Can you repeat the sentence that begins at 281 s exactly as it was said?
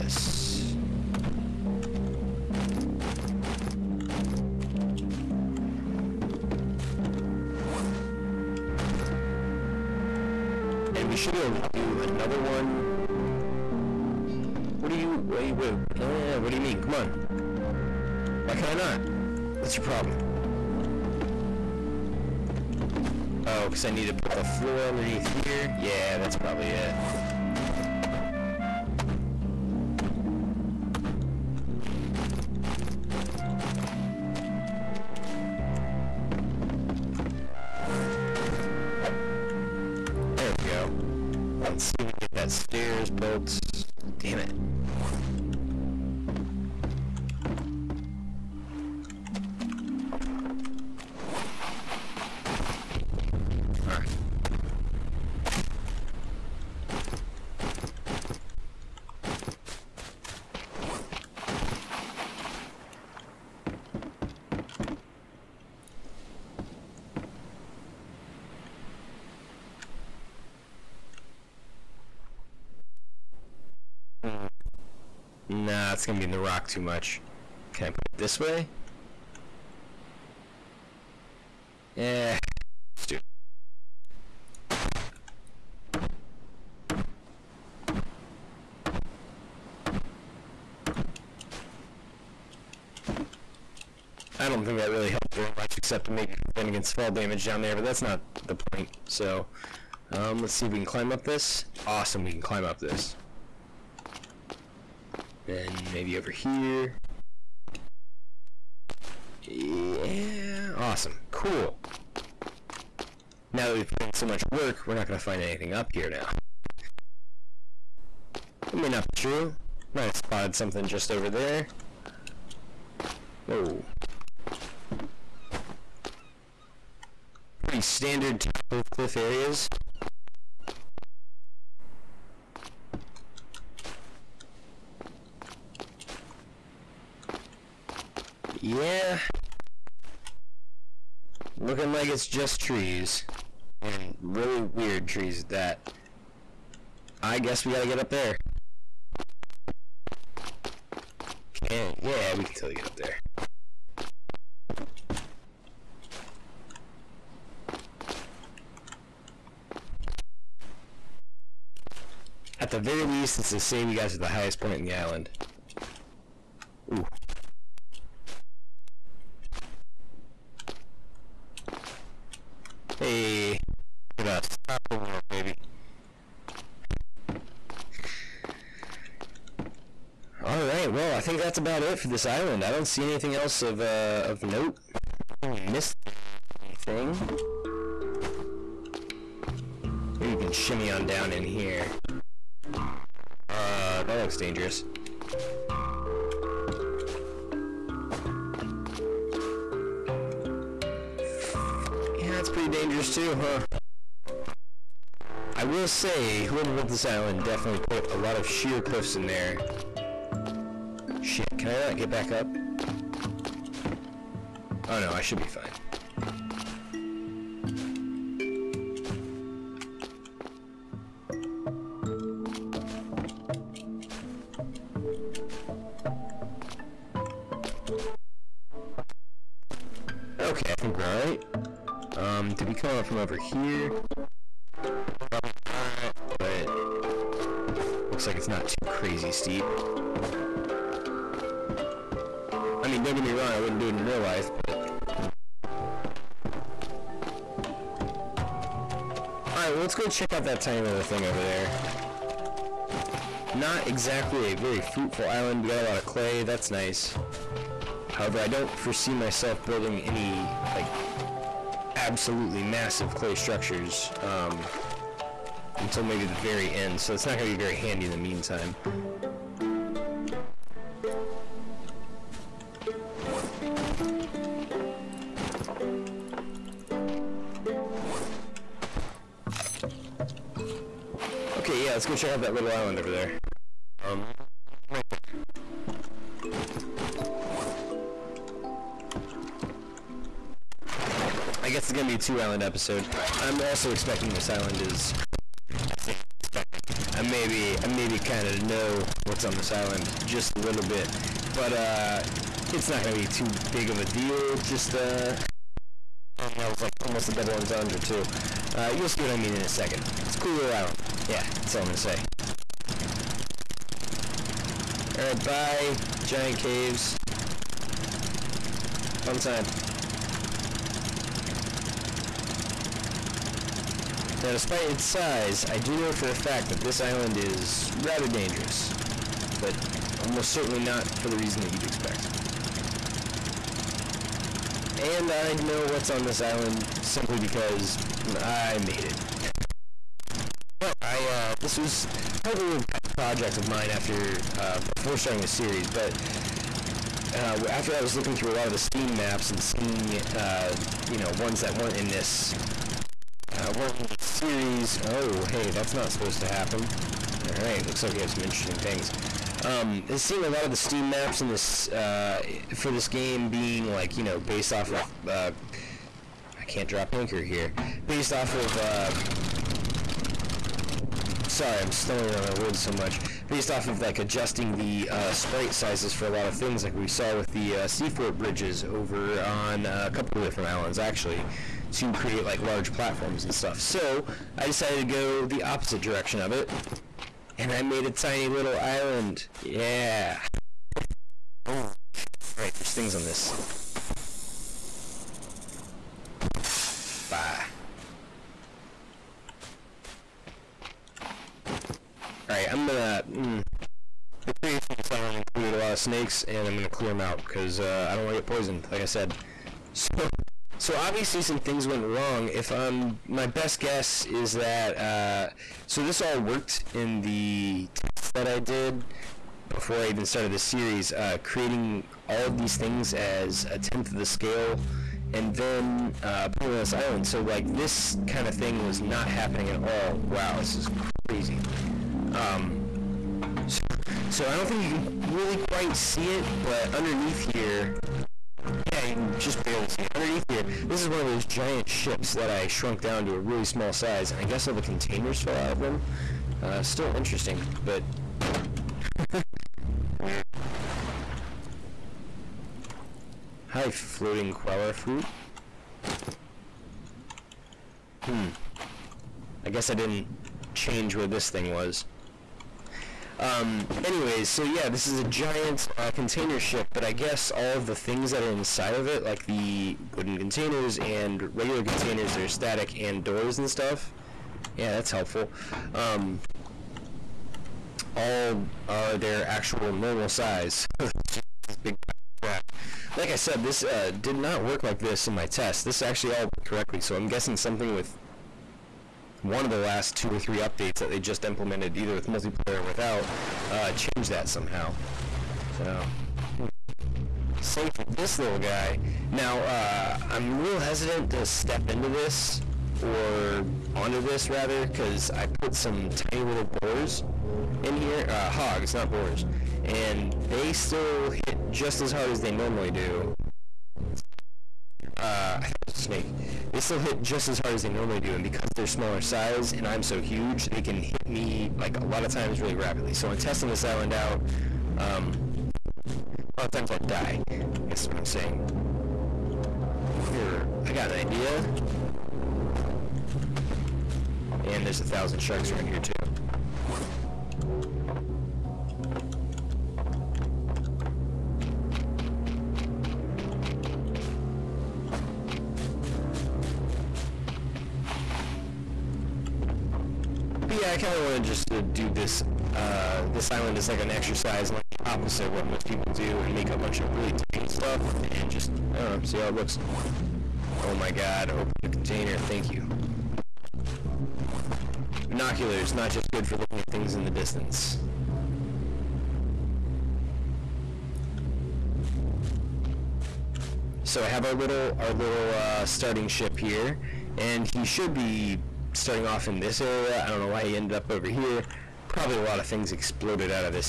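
Okay, yeah, let's go check out that little island over there.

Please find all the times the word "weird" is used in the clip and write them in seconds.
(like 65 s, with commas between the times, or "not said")
144 s, 450 s.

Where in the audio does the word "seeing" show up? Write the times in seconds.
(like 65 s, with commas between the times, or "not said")
349 s, 360 s.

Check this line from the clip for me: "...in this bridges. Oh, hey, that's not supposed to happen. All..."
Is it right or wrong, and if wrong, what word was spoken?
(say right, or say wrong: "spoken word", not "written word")
wrong: "series", not "bridges".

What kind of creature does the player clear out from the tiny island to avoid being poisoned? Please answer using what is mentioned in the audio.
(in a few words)
Snakes.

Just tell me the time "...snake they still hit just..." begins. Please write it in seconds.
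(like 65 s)
515 s.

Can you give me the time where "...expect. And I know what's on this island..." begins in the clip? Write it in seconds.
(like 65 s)
331 s.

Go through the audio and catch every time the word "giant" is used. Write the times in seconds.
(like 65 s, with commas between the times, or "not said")
316 s, 441 s, 465 s.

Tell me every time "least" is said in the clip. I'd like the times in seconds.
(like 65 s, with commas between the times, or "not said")
163 s.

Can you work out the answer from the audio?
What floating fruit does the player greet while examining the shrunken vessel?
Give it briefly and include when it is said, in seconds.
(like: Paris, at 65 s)
Guava, at 454 s.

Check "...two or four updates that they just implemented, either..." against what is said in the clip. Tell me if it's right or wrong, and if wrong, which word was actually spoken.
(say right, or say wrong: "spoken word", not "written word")
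wrong: "three", not "four".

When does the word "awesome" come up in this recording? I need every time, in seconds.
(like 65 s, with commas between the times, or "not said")
101 s, 110 s.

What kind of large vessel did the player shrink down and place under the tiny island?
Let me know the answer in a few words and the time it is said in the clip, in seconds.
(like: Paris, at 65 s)
Container ship, at 466 s.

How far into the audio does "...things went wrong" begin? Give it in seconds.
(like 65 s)
411 s.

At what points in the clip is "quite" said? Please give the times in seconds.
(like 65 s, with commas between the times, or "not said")
435 s.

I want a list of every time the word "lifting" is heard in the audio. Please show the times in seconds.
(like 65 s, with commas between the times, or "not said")
not said.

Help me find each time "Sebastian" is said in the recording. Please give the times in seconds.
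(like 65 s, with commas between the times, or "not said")
not said.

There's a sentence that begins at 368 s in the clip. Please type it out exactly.
Uh, sorry, I'm stumbling around my words so much.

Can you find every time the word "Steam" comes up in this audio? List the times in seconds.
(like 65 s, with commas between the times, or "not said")
348 s, 360 s.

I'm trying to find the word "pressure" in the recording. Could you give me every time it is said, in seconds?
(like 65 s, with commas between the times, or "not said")
not said.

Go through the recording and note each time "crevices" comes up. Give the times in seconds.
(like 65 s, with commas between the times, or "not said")
not said.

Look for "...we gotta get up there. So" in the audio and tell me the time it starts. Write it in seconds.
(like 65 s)
147 s.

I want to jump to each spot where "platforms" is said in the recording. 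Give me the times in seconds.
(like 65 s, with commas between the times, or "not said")
382 s.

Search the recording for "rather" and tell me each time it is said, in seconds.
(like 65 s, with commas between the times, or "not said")
328 s, 504 s.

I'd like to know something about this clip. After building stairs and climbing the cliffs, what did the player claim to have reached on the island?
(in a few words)
The highest point.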